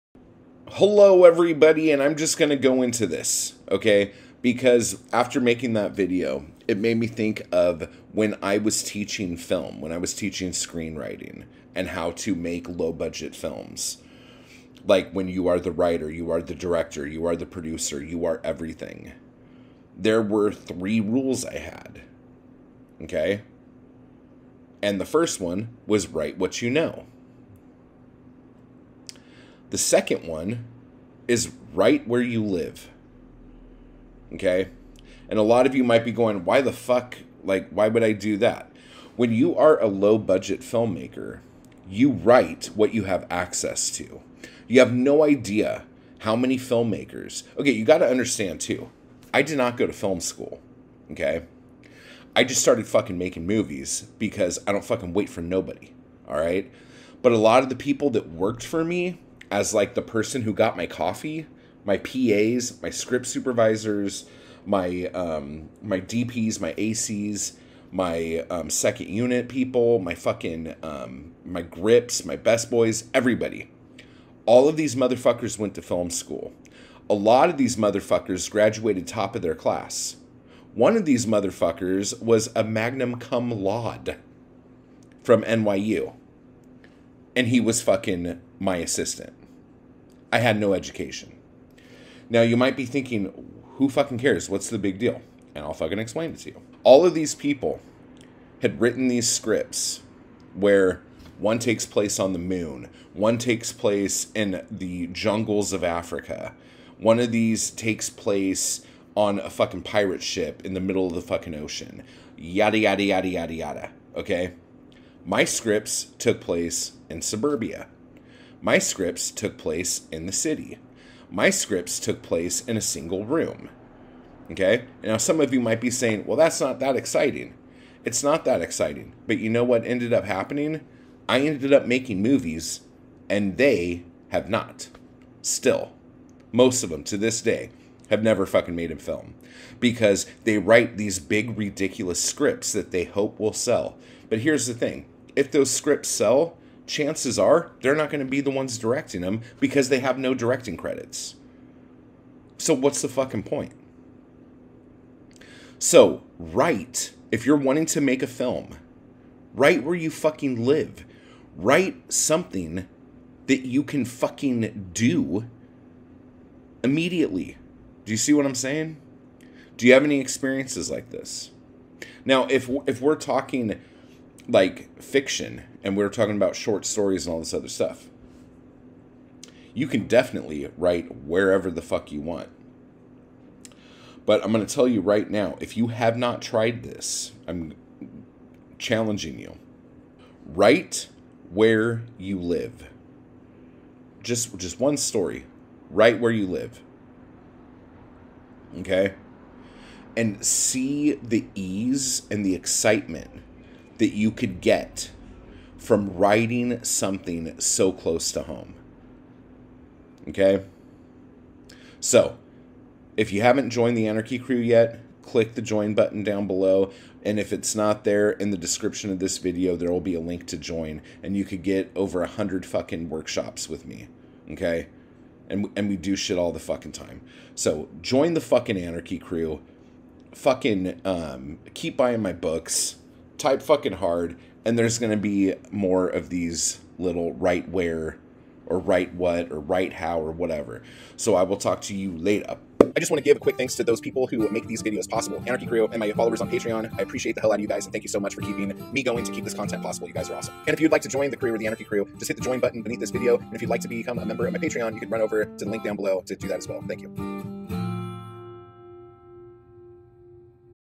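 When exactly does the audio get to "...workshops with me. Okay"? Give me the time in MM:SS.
03:43.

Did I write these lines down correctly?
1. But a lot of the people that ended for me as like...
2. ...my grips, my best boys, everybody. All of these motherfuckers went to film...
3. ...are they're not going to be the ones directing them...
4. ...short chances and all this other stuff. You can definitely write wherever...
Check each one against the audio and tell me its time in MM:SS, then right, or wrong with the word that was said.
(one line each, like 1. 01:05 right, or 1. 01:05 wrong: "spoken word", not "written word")
1. 00:57 wrong: "worked", not "ended"
2. 01:11 right
3. 02:27 right
4. 02:56 wrong: "stories", not "chances".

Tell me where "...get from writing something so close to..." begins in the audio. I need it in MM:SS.
03:24.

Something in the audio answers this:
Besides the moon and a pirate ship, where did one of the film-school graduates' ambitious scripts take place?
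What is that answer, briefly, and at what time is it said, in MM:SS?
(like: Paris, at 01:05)
Jungles of Africa, at 01:45.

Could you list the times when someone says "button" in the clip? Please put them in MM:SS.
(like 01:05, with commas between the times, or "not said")
03:35, 04:12.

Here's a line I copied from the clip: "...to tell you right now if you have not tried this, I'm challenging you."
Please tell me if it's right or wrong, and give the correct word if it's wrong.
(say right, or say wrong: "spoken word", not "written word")
right.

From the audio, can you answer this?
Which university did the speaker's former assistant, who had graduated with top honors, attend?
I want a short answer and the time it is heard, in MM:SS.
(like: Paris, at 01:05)
NYU, at 01:25.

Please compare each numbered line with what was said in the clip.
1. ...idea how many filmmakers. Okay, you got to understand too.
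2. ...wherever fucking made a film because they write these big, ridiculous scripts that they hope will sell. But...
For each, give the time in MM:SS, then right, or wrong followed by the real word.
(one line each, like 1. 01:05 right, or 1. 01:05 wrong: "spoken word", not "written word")
1. 00:45 right
2. 02:18 wrong: "never", not "wherever".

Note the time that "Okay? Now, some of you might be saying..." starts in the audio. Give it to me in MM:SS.
02:04.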